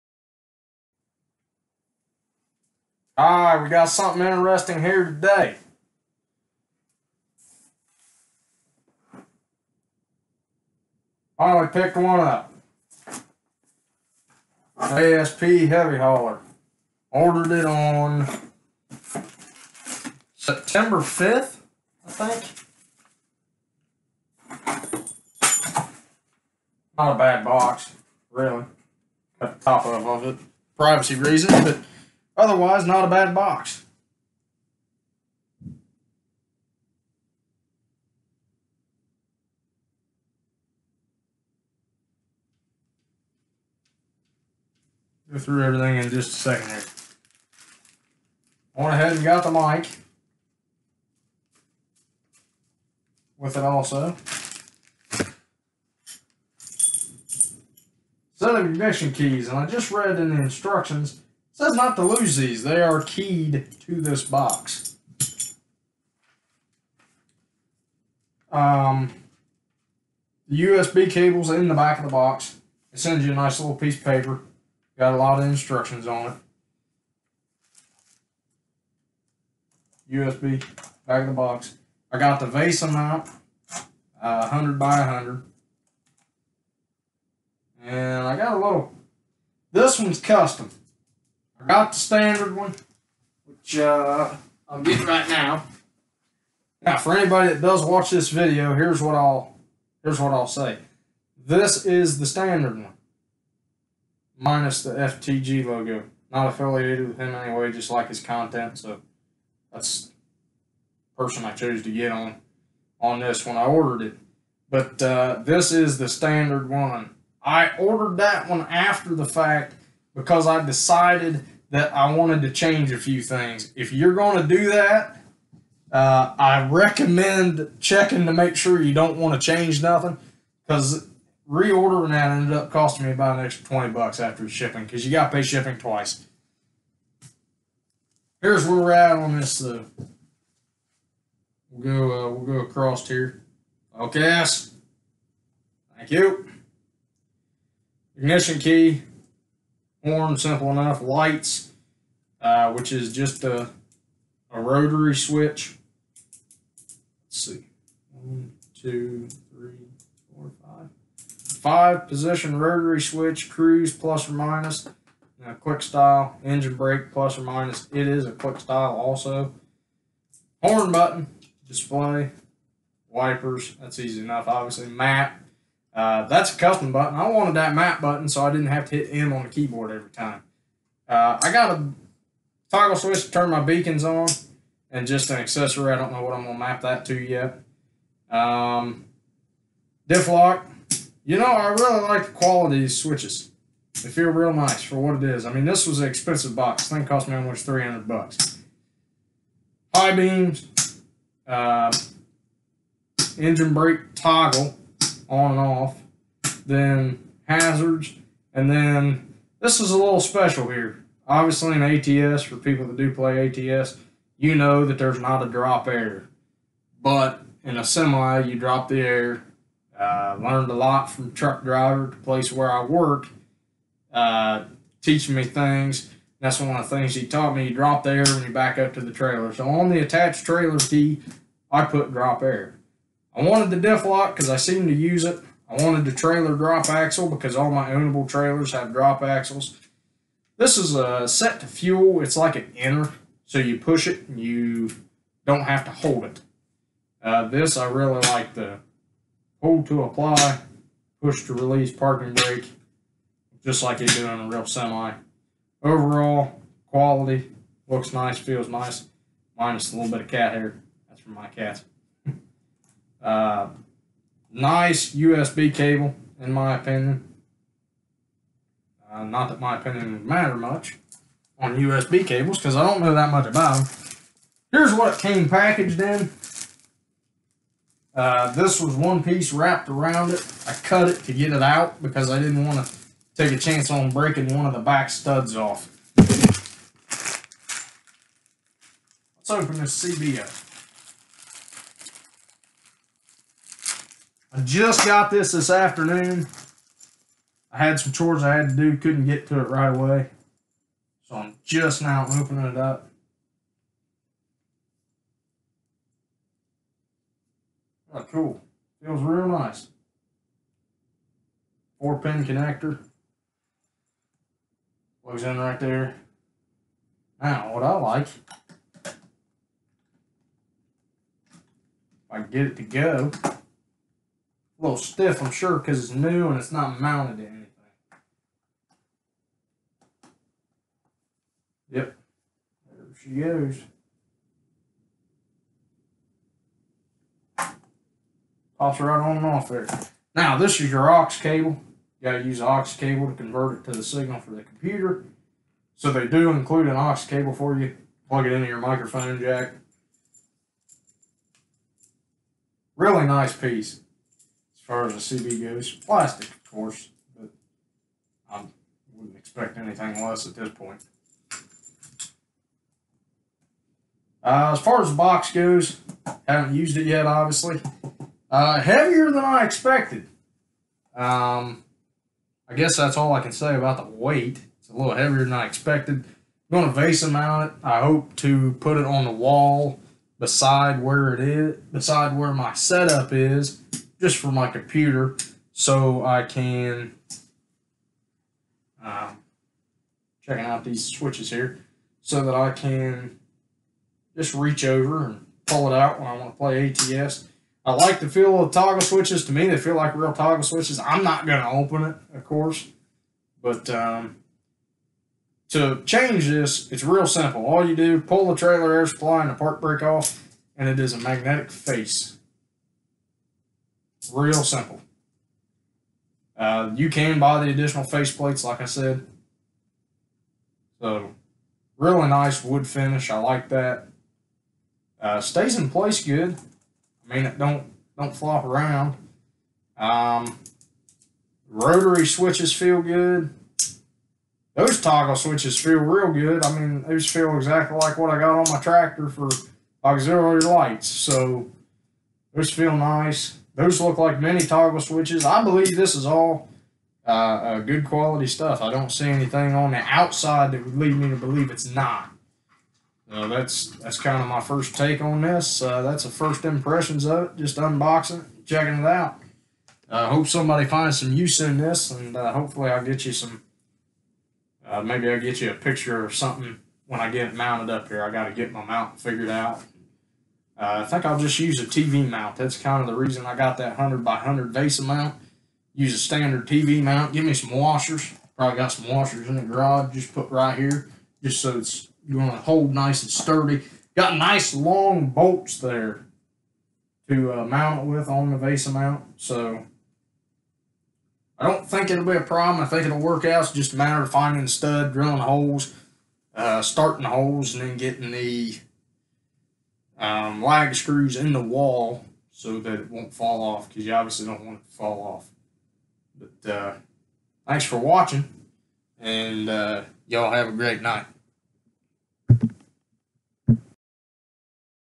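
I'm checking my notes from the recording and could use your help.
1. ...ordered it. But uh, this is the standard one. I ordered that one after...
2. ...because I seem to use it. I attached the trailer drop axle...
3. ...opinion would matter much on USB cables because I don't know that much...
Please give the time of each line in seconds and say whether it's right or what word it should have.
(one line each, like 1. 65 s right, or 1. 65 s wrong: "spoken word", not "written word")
1. 113 s right
2. 234 s wrong: "wanted", not "attached"
3. 269 s right.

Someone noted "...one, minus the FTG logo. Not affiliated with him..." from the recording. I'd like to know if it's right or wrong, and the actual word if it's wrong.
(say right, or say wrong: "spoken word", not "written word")
right.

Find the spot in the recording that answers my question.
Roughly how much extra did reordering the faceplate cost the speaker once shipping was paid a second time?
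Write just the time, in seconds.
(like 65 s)
133 s.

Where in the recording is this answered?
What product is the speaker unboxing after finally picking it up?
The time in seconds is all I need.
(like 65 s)
14 s.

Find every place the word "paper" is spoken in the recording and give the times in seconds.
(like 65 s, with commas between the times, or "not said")
74 s.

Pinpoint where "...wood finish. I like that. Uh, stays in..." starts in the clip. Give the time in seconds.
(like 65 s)
422 s.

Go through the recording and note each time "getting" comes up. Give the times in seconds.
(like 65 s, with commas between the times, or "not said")
94 s, 497 s.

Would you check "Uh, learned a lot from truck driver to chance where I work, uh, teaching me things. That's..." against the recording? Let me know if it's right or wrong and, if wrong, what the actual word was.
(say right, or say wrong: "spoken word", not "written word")
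wrong: "place", not "chance".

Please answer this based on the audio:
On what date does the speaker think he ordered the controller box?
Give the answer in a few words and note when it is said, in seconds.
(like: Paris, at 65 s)
September 5th, at 20 s.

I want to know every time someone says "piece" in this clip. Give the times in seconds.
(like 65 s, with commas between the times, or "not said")
73 s, 279 s, 353 s.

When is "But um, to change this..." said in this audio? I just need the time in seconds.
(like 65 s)
403 s.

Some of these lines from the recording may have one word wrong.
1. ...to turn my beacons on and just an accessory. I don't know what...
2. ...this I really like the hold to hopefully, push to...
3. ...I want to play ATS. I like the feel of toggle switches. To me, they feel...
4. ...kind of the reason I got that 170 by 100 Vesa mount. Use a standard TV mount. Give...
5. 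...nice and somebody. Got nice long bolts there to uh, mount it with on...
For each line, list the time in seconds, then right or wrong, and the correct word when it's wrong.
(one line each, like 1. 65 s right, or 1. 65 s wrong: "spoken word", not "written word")
1. 183 s right
2. 247 s wrong: "apply", not "hopefully"
3. 396 s right
4. 472 s wrong: "100", not "170"
5. 482 s wrong: "sturdy", not "somebody".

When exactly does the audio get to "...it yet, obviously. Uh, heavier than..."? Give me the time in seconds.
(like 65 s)
366 s.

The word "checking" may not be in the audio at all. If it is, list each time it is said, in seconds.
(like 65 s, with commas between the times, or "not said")
127 s, 390 s, 458 s.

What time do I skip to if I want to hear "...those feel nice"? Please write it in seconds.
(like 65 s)
442 s.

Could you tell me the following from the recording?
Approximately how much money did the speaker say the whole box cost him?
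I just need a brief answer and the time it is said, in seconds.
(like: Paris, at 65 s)
300 bucks, at 197 s.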